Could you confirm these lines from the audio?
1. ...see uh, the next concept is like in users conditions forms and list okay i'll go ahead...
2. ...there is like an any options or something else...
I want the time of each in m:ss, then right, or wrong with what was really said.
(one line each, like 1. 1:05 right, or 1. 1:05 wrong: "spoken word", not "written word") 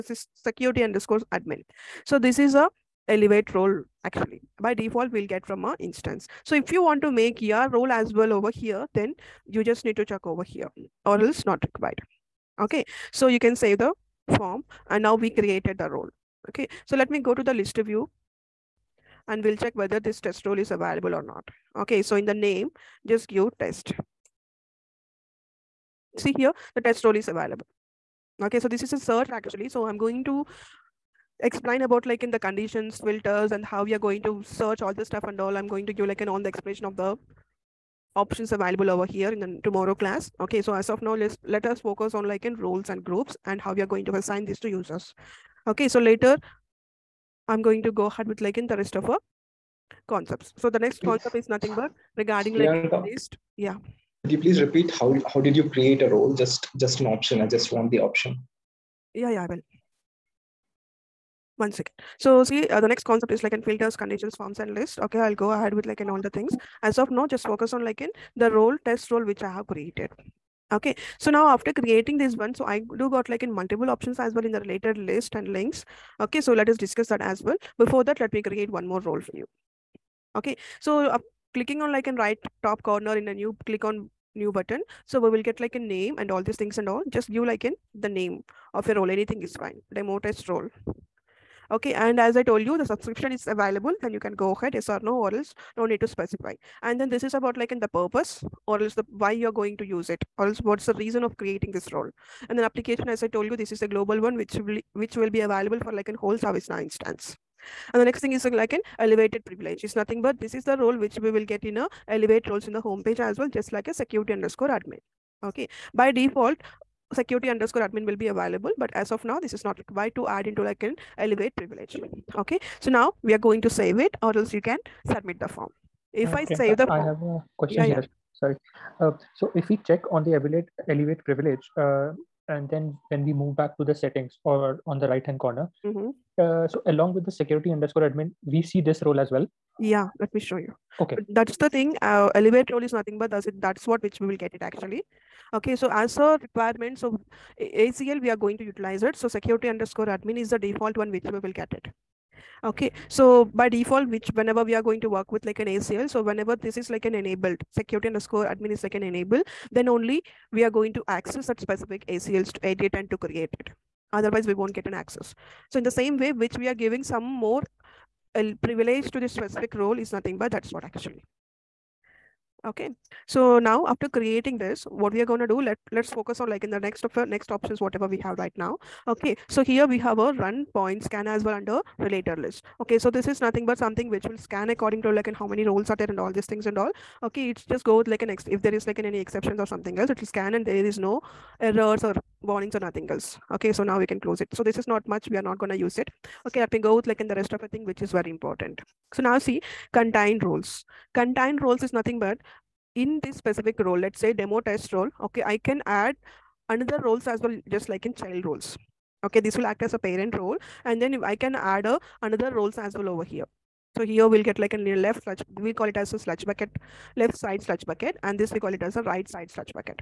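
1. 1:02 wrong: "filters", not "users"
2. 3:08 wrong: "exceptions", not "options".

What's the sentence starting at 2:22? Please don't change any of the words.
Uh, elevate role is nothing but that's it.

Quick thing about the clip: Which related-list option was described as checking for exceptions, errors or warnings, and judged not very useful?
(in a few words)
Run point scan.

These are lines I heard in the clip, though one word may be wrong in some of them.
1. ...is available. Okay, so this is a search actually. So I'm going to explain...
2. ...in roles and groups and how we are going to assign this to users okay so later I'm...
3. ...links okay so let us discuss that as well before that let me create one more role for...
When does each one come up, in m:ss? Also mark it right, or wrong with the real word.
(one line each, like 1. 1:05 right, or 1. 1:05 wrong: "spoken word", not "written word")
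1. 0:27 right
2. 0:42 right
3. 1:15 right.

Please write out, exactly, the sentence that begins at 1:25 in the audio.
So we will get like a name and all these things and all.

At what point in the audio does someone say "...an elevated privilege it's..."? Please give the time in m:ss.
1:48.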